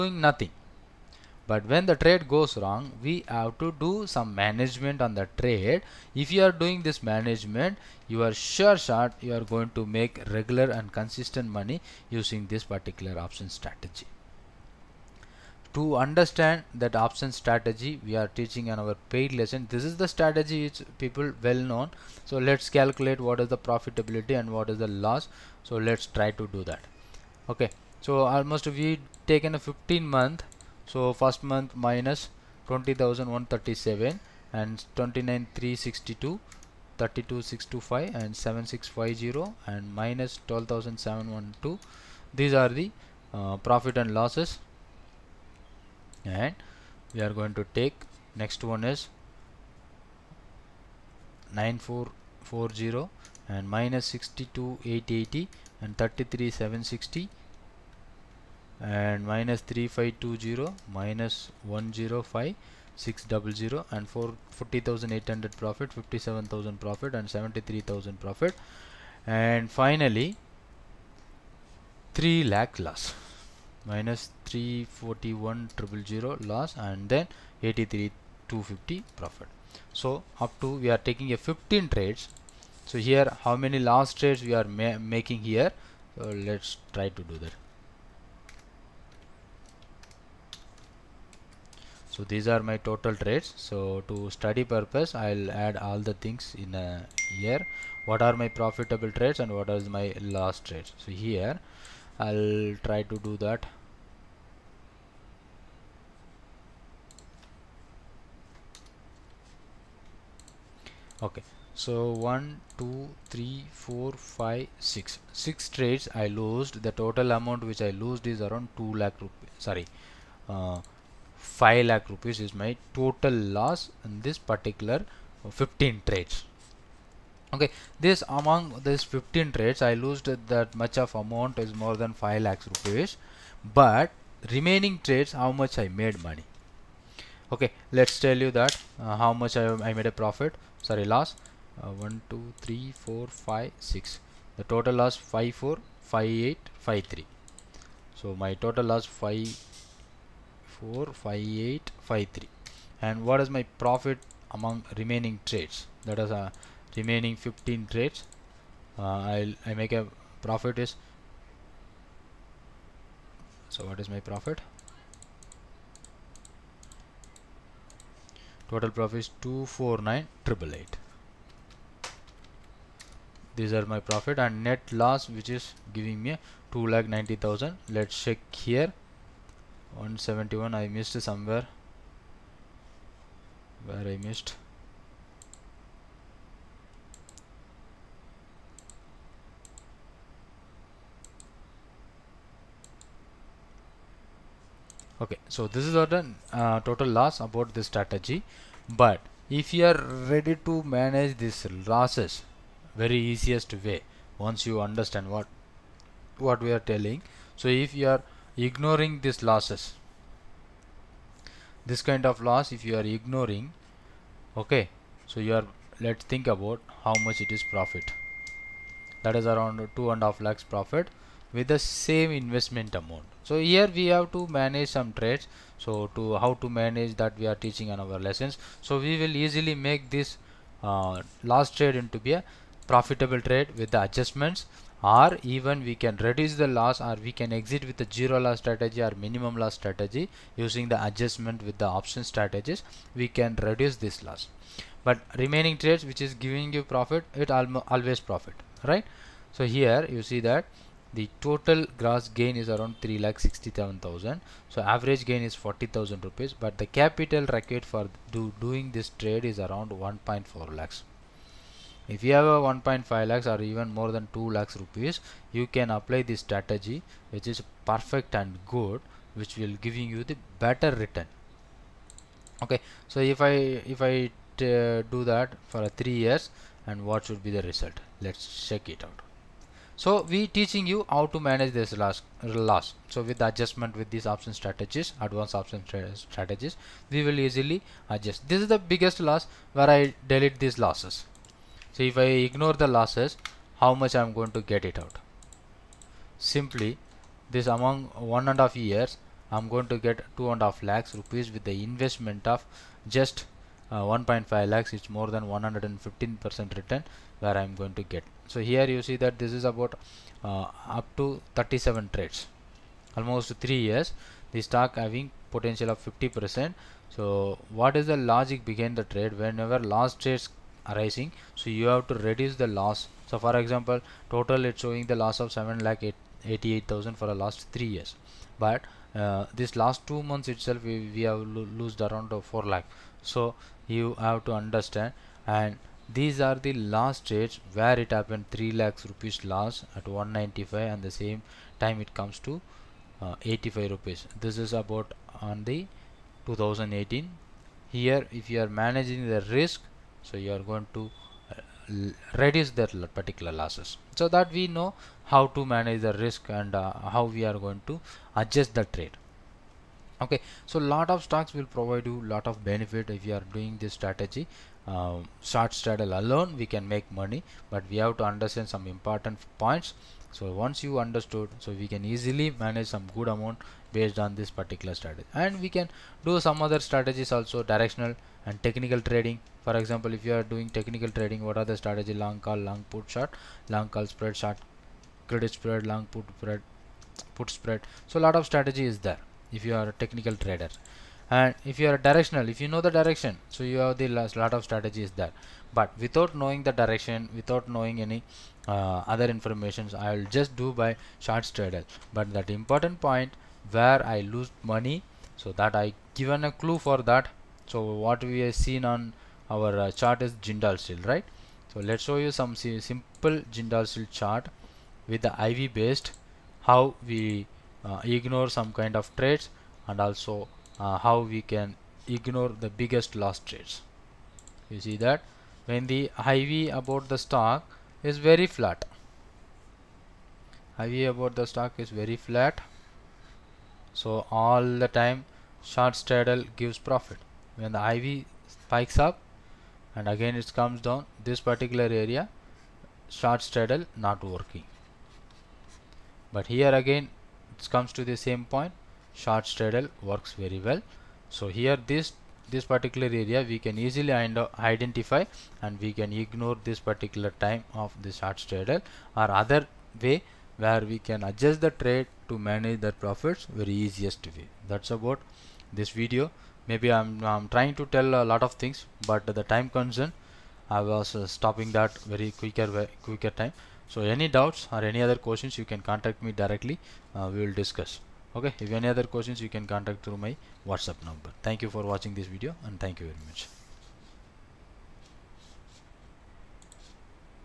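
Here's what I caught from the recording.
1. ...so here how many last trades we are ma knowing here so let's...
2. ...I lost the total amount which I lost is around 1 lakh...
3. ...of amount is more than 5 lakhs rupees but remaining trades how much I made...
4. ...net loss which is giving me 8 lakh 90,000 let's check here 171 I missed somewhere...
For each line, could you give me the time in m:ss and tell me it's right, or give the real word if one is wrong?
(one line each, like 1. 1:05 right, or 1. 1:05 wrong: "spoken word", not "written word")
1. 1:22 wrong: "making", not "knowing"
2. 1:56 wrong: "2", not "1"
3. 2:10 right
4. 2:54 wrong: "2", not "8".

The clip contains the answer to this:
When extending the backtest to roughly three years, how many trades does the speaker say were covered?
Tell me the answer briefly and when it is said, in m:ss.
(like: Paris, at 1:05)
37, at 5:11.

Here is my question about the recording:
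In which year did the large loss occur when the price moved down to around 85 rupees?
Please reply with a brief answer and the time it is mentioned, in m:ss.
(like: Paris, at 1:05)
2018, at 5:46.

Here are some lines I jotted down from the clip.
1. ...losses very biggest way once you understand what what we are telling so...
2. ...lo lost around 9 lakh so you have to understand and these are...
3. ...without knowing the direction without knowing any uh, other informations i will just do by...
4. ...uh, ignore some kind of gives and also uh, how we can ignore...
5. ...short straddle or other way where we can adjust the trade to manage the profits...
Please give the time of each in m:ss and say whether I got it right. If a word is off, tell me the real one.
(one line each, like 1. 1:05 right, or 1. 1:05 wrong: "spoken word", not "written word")
1. 3:21 wrong: "easiest", not "biggest"
2. 5:31 wrong: "4", not "9"
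3. 6:36 right
4. 6:57 wrong: "trades", not "gives"
5. 7:38 right.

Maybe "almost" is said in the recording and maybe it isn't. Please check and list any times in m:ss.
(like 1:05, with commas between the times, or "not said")
0:28, 5:13.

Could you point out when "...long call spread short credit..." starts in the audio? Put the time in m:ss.
6:23.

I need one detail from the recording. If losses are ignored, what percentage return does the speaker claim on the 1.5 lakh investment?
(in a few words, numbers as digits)
115 percent.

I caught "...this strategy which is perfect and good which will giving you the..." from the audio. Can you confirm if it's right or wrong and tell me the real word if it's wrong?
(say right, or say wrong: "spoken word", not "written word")
right.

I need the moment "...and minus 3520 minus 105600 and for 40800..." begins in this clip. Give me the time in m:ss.
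0:58.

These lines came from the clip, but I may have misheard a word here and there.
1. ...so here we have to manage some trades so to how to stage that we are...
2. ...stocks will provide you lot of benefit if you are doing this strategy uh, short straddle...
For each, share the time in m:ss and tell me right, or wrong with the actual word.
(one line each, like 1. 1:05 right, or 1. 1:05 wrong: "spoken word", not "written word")
1. 3:43 wrong: "manage", not "stage"
2. 6:01 right.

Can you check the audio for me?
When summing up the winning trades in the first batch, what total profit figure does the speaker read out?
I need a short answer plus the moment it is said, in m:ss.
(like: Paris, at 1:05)
249888, at 2:49.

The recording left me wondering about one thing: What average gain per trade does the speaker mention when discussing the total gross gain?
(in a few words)
40,000 rupees.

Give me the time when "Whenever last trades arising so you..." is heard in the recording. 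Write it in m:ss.
5:19.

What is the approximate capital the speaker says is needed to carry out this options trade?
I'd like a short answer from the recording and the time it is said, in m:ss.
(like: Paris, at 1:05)
1.4 lakhs, at 4:20.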